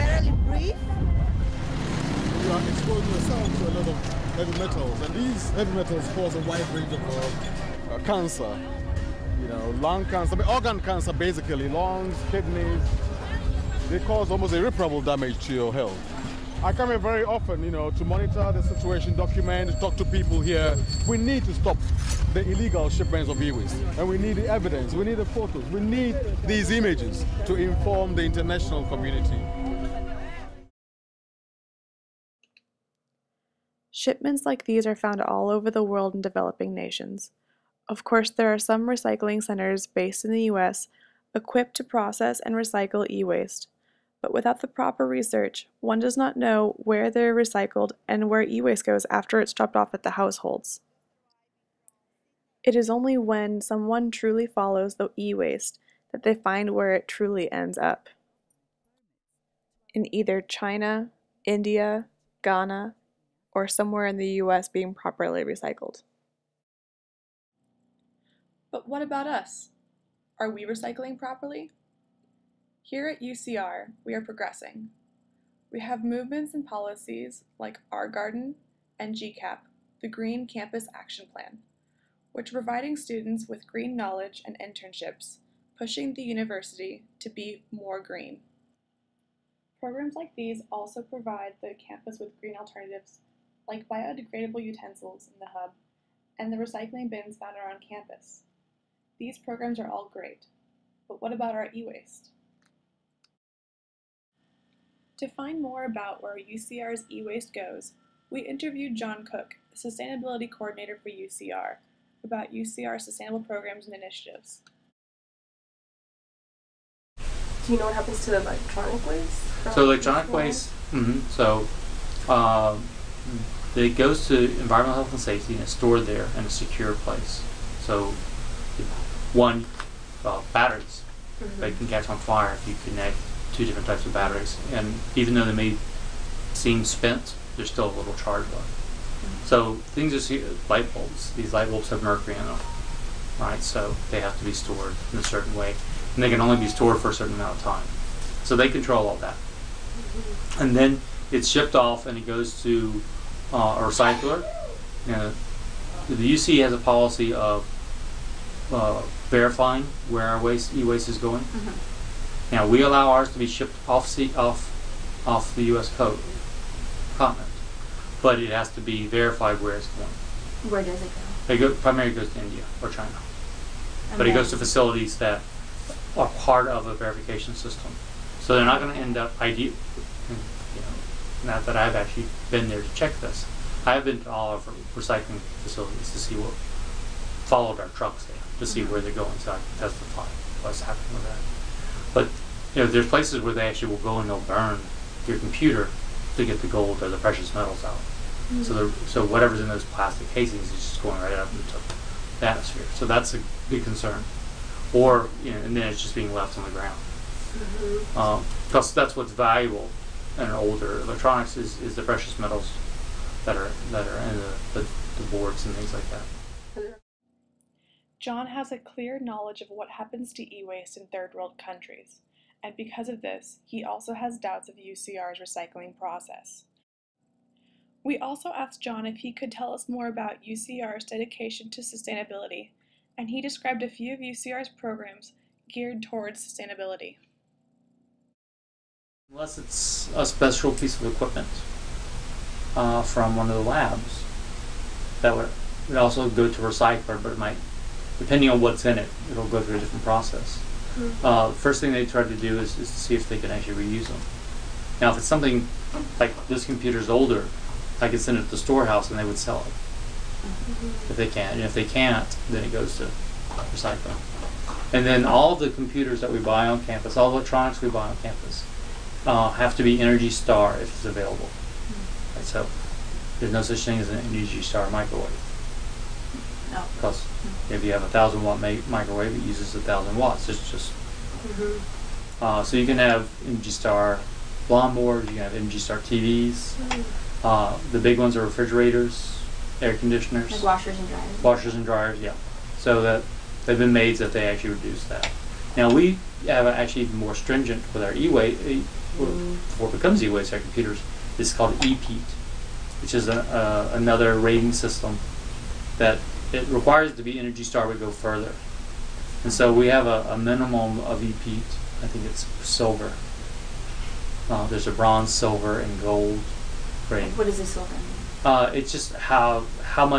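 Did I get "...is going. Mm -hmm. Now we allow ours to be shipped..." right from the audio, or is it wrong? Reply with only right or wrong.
right.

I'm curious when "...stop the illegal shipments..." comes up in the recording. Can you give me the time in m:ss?
0:21.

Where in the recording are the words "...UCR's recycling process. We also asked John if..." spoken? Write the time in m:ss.
3:44.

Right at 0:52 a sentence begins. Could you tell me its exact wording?
It is only when someone truly follows the e-waste that they find where it truly ends up.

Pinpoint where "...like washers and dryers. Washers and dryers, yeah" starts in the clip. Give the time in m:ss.
4:50.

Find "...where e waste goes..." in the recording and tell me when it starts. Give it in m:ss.
0:48.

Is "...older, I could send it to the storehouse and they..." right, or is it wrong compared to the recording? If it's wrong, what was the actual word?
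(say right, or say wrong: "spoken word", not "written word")
right.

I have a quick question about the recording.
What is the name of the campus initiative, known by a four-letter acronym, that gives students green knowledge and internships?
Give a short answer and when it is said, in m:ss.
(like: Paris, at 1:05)
Green Campus Action Plan, at 1:19.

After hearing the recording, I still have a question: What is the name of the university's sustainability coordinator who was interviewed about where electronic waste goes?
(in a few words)
John Cook.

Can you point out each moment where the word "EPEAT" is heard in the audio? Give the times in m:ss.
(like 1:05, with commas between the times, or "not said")
5:01, 5:11.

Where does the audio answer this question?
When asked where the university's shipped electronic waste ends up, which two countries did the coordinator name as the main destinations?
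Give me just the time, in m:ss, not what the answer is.
2:52.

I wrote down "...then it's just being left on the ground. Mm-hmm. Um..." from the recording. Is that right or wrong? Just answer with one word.
right.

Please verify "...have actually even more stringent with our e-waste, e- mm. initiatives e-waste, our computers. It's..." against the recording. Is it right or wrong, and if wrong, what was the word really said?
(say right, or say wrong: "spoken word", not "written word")
wrong: "becomes", not "initiatives".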